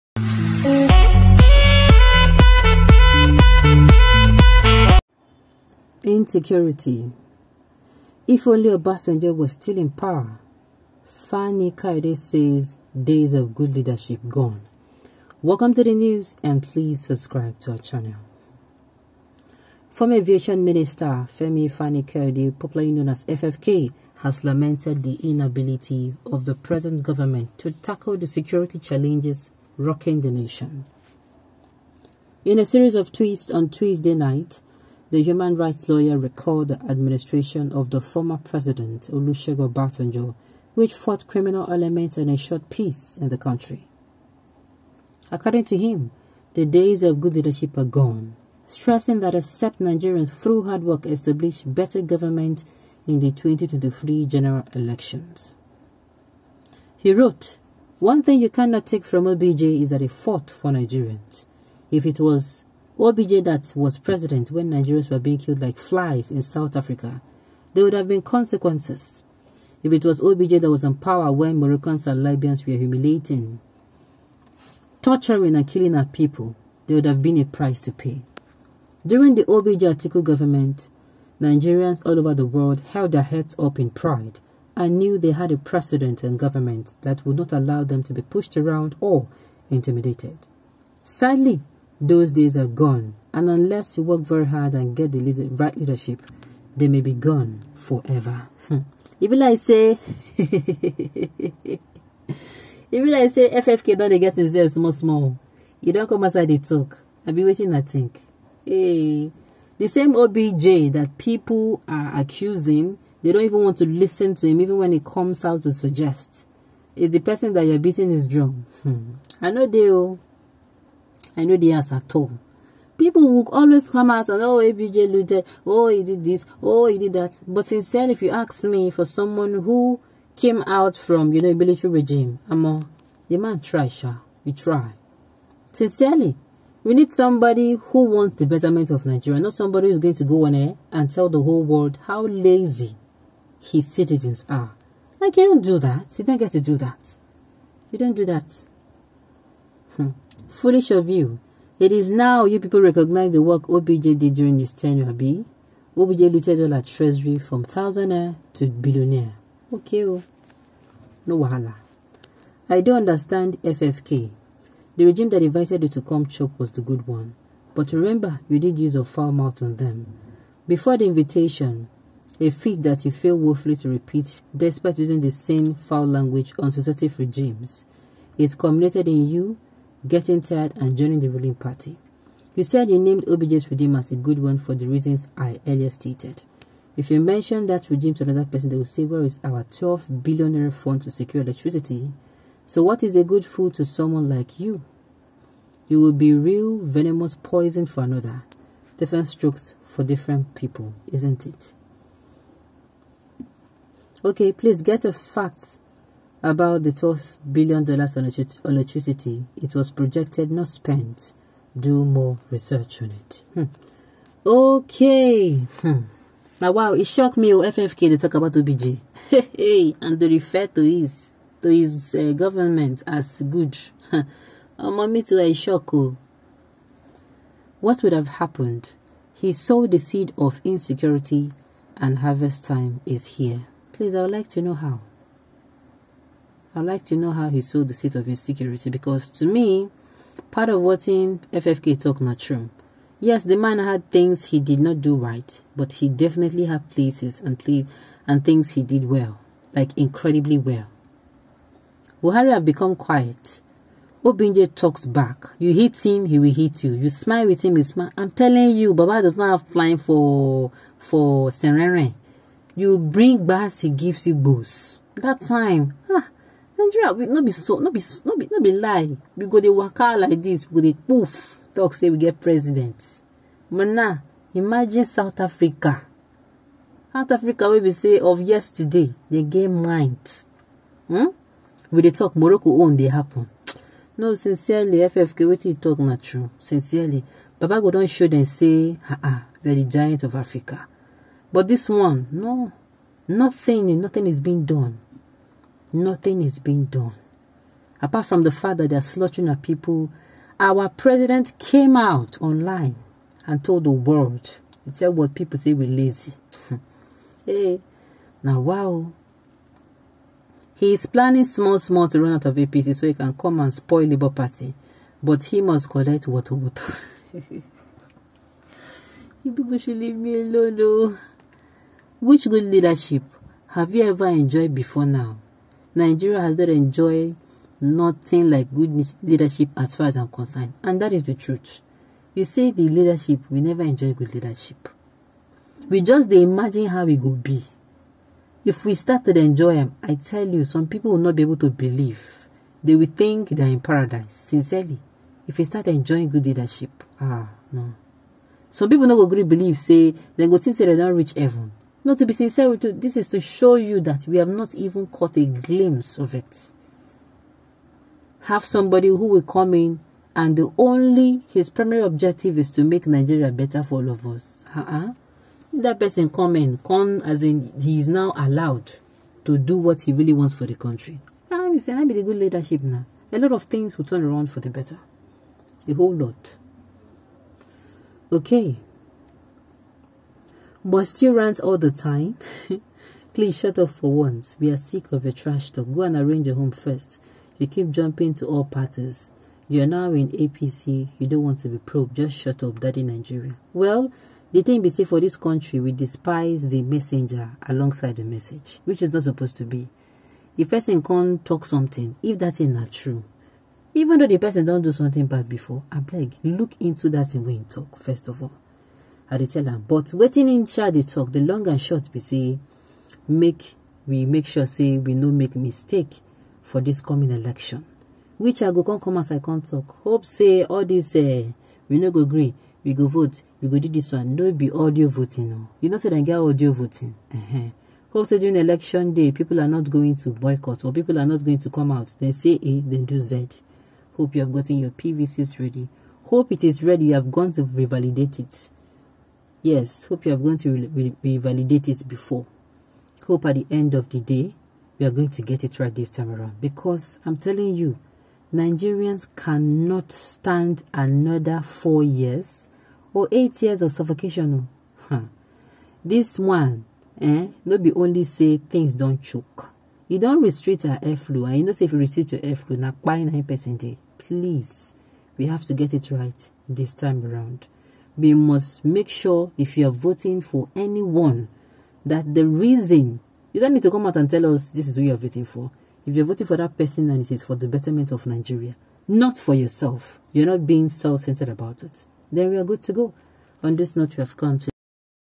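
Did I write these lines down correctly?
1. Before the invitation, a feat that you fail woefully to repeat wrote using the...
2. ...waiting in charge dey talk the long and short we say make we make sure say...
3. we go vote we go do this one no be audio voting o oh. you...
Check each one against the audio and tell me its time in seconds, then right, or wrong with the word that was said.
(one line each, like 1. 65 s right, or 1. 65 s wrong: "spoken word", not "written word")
1. 170 s wrong: "despite", not "wrote"
2. 410 s right
3. 422 s right.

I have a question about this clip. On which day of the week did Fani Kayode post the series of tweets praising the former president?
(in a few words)
Tuesday.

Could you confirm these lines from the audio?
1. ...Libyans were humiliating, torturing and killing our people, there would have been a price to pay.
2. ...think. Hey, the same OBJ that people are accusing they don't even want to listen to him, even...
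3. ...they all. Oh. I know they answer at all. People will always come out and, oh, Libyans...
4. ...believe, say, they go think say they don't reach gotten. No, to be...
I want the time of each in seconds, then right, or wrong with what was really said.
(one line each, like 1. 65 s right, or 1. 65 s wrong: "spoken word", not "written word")
1. 72 s right
2. 107 s right
3. 119 s wrong: "ABJ", not "Libyans"
4. 349 s wrong: "heaven", not "gotten".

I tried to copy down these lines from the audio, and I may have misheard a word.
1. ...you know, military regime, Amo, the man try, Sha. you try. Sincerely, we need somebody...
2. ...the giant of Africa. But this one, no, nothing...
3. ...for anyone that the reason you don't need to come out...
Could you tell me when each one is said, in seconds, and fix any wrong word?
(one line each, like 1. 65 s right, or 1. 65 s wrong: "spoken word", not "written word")
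1. 131 s right
2. 289 s right
3. 470 s right.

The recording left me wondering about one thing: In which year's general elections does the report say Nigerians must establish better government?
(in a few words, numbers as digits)
2023.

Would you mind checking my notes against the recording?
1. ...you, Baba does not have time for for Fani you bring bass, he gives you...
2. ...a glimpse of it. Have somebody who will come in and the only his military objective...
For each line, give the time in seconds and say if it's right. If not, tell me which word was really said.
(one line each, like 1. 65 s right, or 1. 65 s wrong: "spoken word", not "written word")
1. 258 s wrong: "Serene", not "Fani"
2. 355 s wrong: "primary", not "military".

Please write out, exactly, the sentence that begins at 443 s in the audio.
Hope at the end of the day, we are going to get it right this time around.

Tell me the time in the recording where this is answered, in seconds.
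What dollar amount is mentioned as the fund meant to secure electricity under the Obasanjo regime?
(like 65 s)
189 s.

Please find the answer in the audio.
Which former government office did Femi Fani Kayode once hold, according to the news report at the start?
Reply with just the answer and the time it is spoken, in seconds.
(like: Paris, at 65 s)
Aviation Minister, at 20 s.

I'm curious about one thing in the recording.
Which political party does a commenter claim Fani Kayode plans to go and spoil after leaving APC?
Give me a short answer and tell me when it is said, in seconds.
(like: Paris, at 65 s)
Labour Party, at 314 s.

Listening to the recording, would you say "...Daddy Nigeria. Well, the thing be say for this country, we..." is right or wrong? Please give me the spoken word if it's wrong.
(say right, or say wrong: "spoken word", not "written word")
right.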